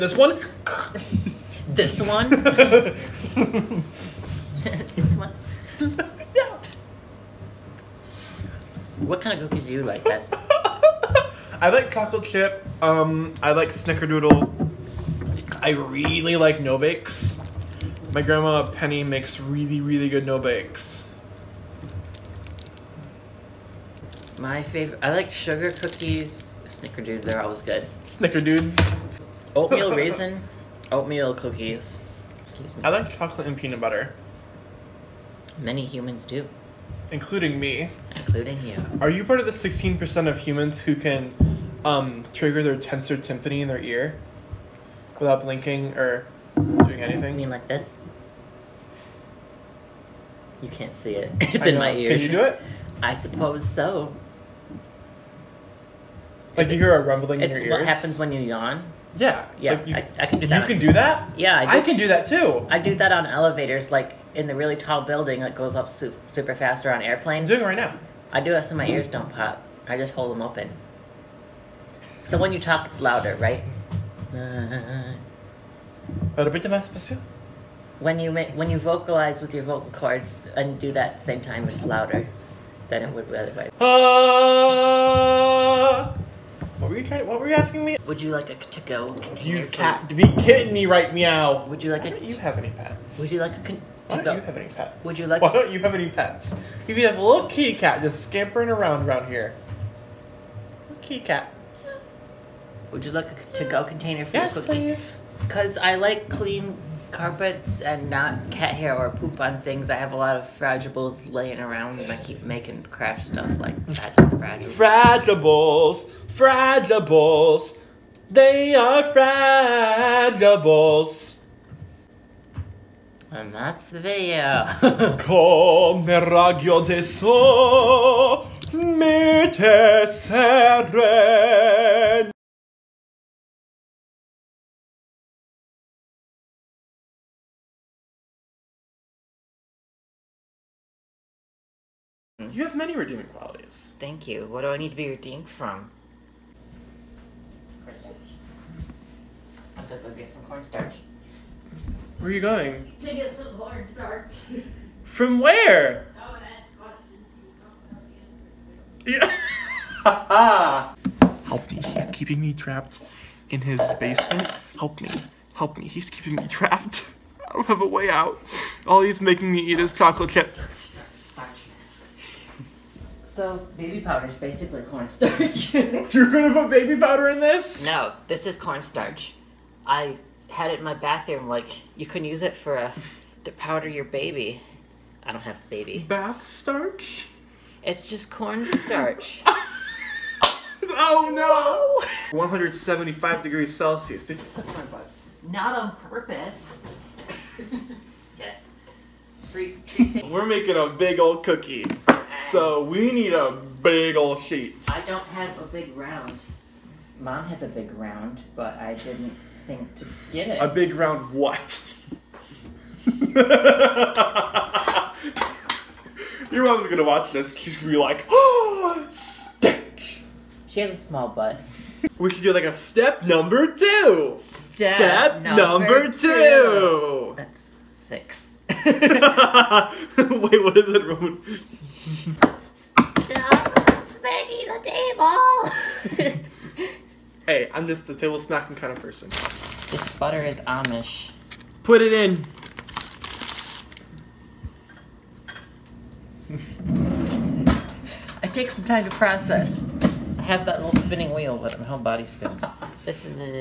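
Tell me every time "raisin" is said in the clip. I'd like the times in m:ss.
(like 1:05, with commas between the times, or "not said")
0:29.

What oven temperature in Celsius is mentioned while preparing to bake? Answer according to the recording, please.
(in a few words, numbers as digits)
175 degrees Celsius.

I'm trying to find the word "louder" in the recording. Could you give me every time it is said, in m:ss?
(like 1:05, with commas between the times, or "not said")
1:13, 1:21.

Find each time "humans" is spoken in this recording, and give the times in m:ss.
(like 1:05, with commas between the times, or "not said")
0:35, 0:40.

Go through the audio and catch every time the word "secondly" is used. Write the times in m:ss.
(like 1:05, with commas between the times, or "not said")
not said.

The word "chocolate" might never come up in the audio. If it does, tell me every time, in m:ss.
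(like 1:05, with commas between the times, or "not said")
0:11, 0:33, 2:49.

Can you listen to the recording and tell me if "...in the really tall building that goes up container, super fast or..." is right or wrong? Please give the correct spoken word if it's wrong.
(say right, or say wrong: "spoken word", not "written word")
wrong: "super", not "container".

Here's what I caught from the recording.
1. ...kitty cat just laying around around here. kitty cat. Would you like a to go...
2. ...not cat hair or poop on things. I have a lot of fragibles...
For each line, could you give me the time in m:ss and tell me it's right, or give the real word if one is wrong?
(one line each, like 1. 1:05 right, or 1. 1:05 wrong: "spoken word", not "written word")
1. 1:37 wrong: "scampering", not "laying"
2. 1:48 right.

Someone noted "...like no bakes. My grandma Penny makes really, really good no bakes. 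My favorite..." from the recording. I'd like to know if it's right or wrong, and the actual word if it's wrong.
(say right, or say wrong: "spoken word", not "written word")
right.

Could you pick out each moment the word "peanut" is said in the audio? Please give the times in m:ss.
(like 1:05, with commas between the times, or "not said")
0:33.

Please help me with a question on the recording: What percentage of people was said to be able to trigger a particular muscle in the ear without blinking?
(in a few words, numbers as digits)
16%.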